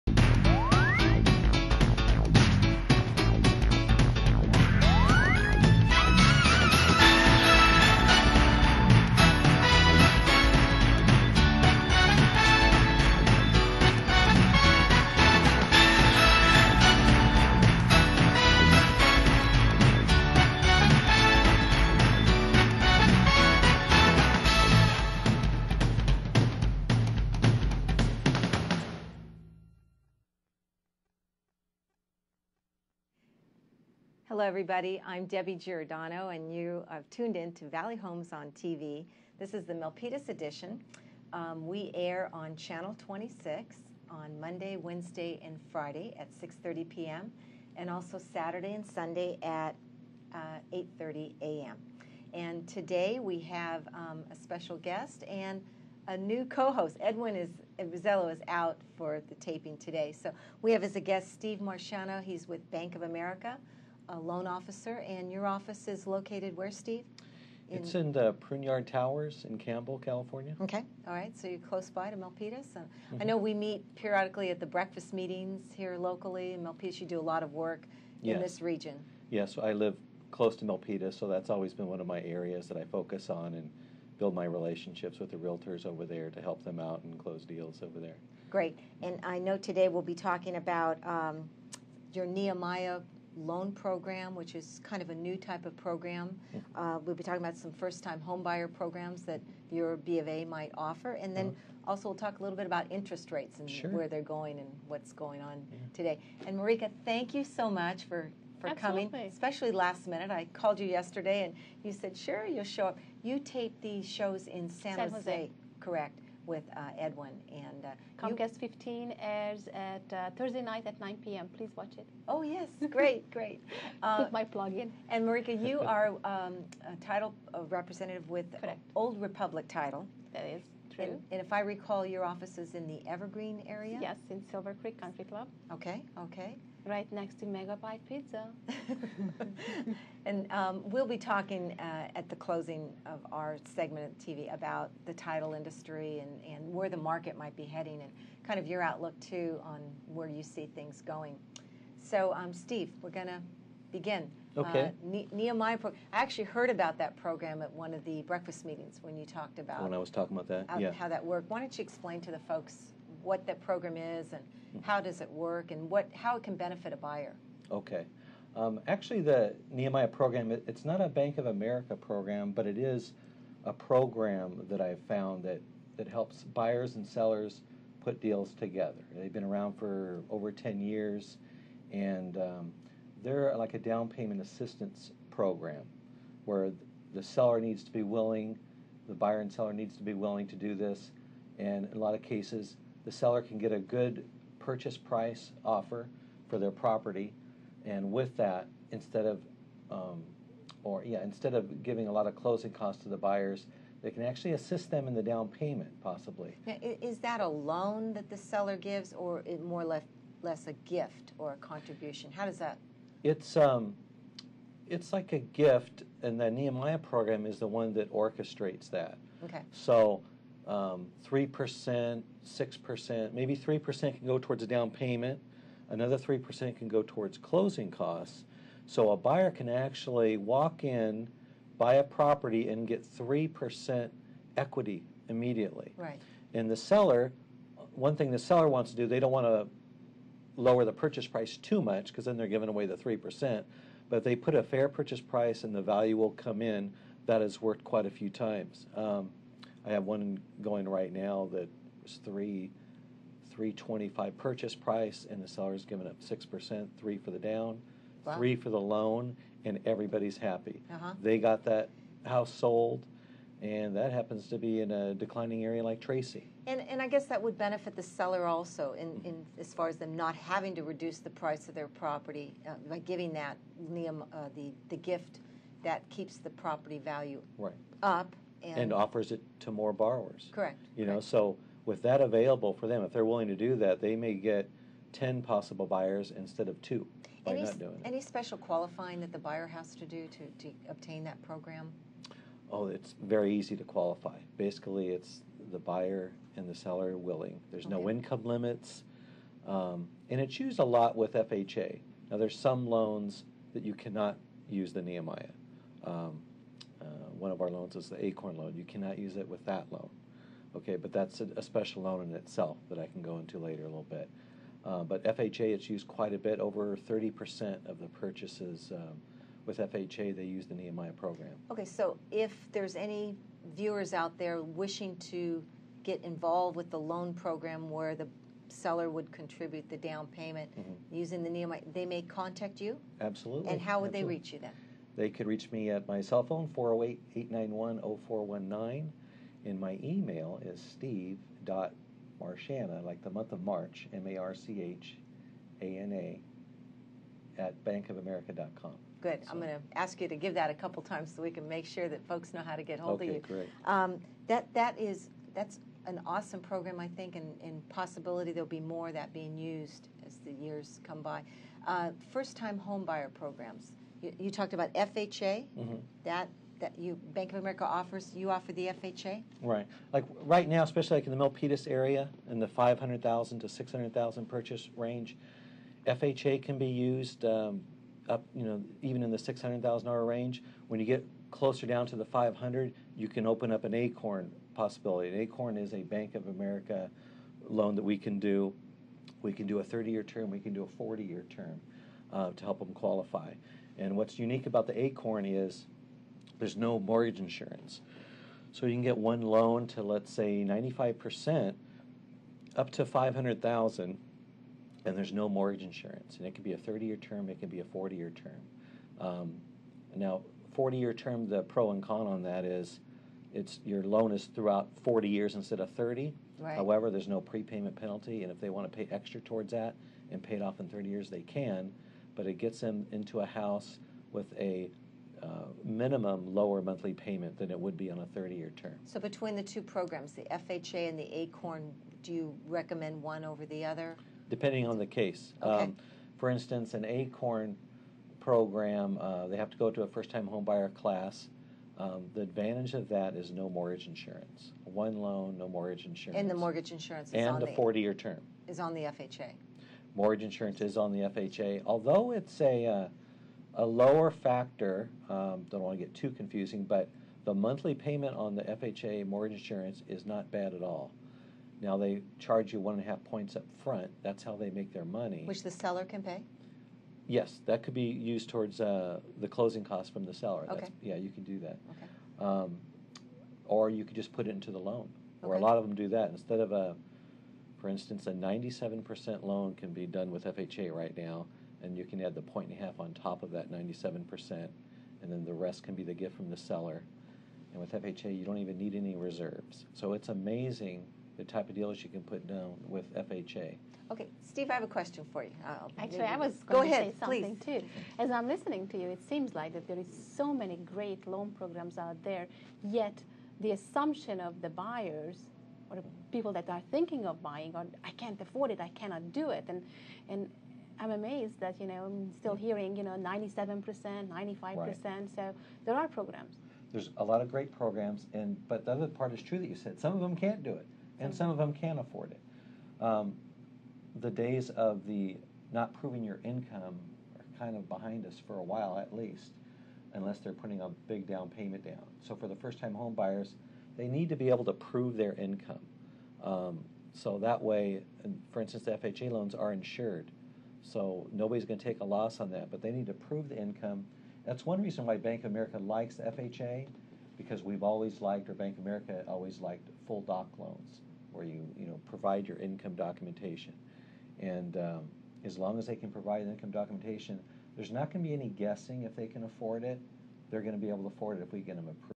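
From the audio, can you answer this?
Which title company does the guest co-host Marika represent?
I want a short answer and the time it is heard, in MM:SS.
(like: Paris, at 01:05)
Old Republic, at 02:08.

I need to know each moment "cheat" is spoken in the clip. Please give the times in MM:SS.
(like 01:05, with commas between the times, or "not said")
not said.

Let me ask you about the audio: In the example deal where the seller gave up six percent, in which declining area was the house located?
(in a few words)
Tracy.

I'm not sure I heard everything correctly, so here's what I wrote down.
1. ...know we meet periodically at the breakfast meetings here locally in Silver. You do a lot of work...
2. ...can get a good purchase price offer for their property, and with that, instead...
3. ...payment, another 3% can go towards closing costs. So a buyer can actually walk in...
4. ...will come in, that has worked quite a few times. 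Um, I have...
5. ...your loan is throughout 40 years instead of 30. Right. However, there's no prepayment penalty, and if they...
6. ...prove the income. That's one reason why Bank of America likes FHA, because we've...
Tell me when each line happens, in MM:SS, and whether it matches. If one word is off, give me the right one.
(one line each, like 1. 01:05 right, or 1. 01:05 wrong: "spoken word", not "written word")
1. 01:13 wrong: "Milpitas", not "Silver"
2. 03:13 right
3. 03:44 right
4. 04:06 right
5. 06:53 right
6. 09:03 right.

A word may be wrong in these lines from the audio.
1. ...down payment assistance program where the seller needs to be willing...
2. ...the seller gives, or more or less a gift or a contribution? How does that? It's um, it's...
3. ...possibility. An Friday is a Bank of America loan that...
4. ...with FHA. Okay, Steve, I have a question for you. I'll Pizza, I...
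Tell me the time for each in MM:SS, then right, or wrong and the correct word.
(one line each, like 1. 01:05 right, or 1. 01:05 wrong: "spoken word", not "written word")
1. 03:03 right
2. 03:28 right
3. 06:24 wrong: "ACORN", not "Friday"
4. 08:12 wrong: "Actually", not "Pizza".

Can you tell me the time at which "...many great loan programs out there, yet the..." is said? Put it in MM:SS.
08:20.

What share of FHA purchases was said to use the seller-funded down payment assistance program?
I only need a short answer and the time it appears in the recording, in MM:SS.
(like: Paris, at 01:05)
Over 30%, at 05:16.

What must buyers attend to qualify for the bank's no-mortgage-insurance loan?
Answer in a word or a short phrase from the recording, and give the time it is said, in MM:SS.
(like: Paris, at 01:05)
First time homebuyer class, at 07:20.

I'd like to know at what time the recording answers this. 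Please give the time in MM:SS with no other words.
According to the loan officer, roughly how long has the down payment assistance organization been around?
03:00.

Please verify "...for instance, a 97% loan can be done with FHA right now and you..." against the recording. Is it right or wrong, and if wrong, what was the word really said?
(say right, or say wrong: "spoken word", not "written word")
right.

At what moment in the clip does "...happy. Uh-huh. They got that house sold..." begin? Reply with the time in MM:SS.
04:20.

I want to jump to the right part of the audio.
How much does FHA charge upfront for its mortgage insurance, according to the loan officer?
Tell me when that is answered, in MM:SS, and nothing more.
07:42.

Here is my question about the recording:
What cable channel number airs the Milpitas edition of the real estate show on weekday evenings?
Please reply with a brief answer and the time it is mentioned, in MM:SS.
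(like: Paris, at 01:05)
26, at 00:42.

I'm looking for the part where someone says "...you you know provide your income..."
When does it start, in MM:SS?
09:11.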